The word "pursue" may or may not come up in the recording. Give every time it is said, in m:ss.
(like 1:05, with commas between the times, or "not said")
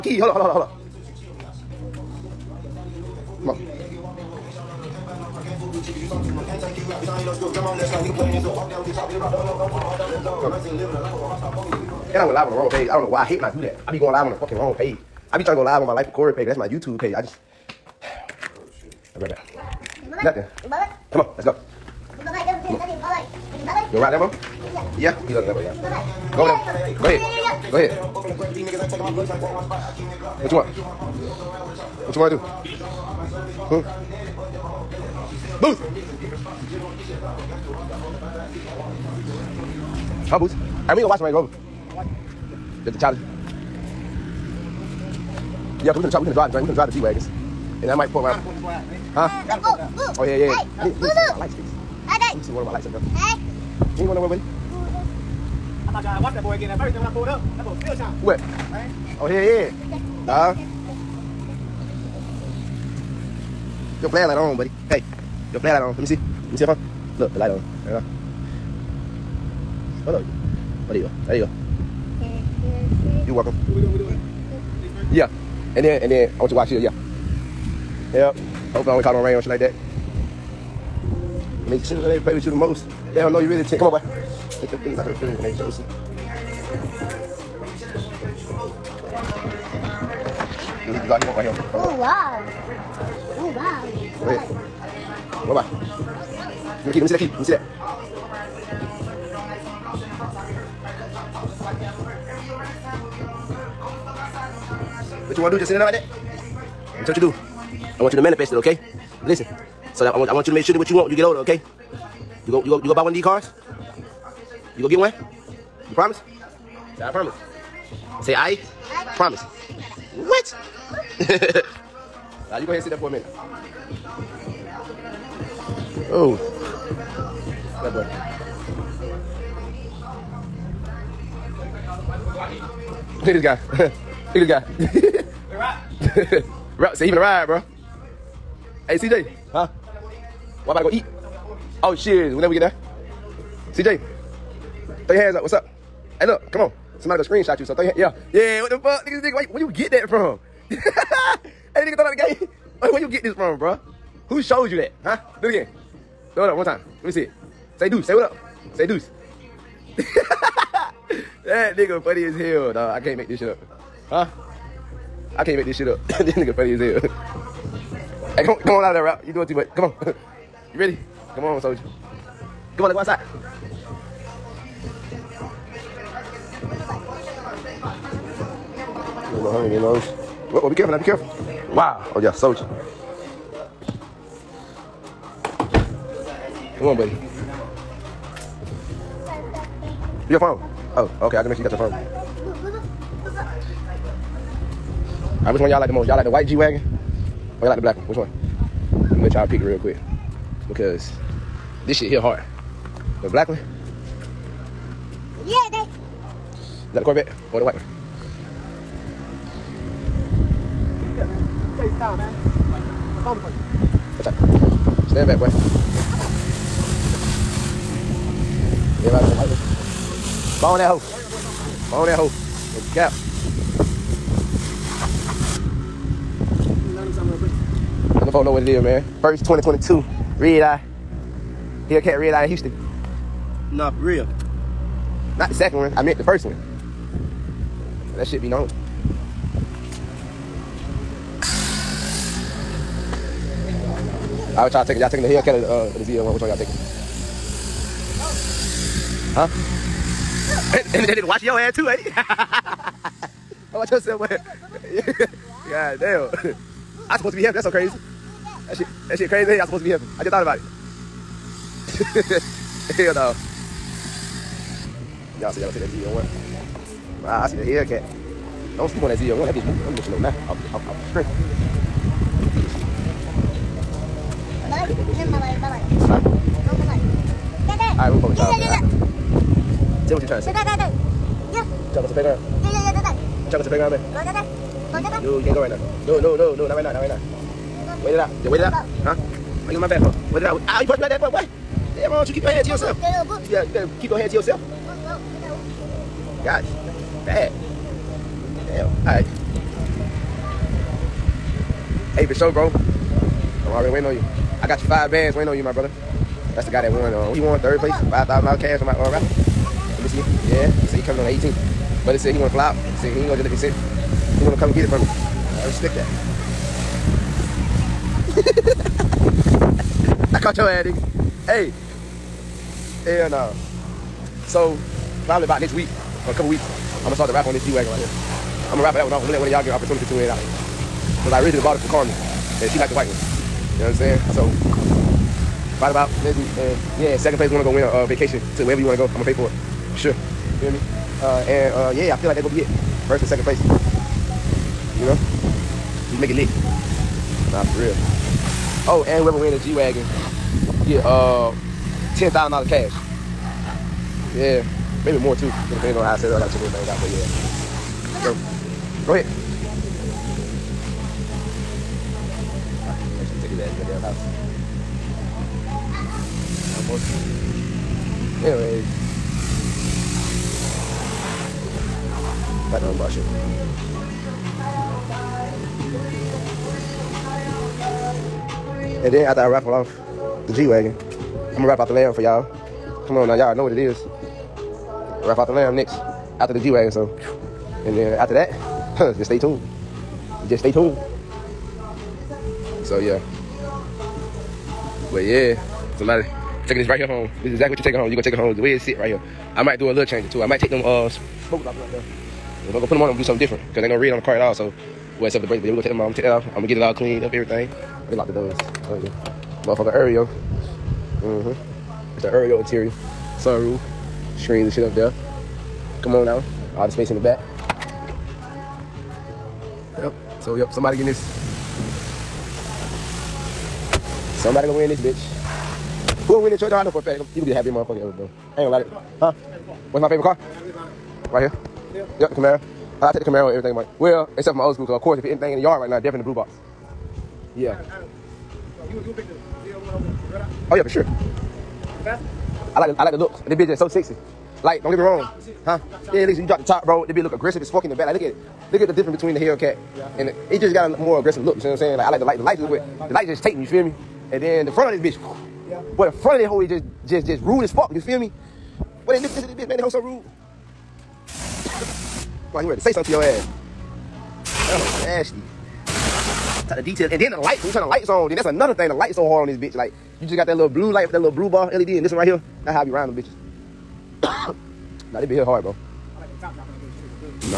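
not said.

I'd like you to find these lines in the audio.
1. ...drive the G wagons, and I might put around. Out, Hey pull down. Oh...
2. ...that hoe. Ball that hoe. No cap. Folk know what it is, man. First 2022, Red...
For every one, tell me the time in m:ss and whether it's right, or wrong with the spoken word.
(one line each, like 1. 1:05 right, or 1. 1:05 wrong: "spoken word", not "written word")
1. 0:46 wrong: "Gotta", not "Hey"
2. 3:40 right.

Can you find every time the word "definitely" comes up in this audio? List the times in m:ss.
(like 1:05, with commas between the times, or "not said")
7:15.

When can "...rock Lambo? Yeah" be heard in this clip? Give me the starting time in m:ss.
0:23.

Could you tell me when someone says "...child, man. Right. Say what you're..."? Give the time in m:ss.
4:38.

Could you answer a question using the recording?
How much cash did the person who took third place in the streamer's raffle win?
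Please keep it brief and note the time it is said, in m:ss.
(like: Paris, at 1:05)
$5,000, at 5:08.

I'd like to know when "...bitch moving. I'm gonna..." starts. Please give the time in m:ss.
4:29.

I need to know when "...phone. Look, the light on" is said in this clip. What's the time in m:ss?
1:06.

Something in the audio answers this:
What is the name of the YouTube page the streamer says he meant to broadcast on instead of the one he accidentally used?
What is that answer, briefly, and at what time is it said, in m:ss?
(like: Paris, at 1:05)
Life with Corey, at 0:15.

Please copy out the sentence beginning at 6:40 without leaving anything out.
I might take them uh smokers off right there.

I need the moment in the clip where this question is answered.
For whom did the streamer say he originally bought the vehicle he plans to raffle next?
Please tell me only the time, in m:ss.
5:31.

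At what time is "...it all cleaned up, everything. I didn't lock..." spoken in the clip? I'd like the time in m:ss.
6:46.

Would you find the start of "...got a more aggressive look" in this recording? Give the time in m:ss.
7:30.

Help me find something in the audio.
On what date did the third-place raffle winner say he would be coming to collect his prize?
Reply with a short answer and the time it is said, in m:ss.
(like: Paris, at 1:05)
the 18th, at 5:11.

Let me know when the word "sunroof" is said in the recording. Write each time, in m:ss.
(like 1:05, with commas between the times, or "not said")
6:53.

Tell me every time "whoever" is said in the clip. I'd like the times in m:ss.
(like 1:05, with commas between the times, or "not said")
5:49, 7:06.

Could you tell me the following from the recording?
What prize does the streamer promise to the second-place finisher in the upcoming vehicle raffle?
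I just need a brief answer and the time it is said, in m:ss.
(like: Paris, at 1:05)
A vacation, at 5:38.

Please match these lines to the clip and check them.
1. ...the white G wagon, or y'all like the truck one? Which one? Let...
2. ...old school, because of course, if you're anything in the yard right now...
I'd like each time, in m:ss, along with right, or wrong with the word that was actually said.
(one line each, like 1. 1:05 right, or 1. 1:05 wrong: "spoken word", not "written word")
1. 3:16 wrong: "black", not "truck"
2. 7:14 right.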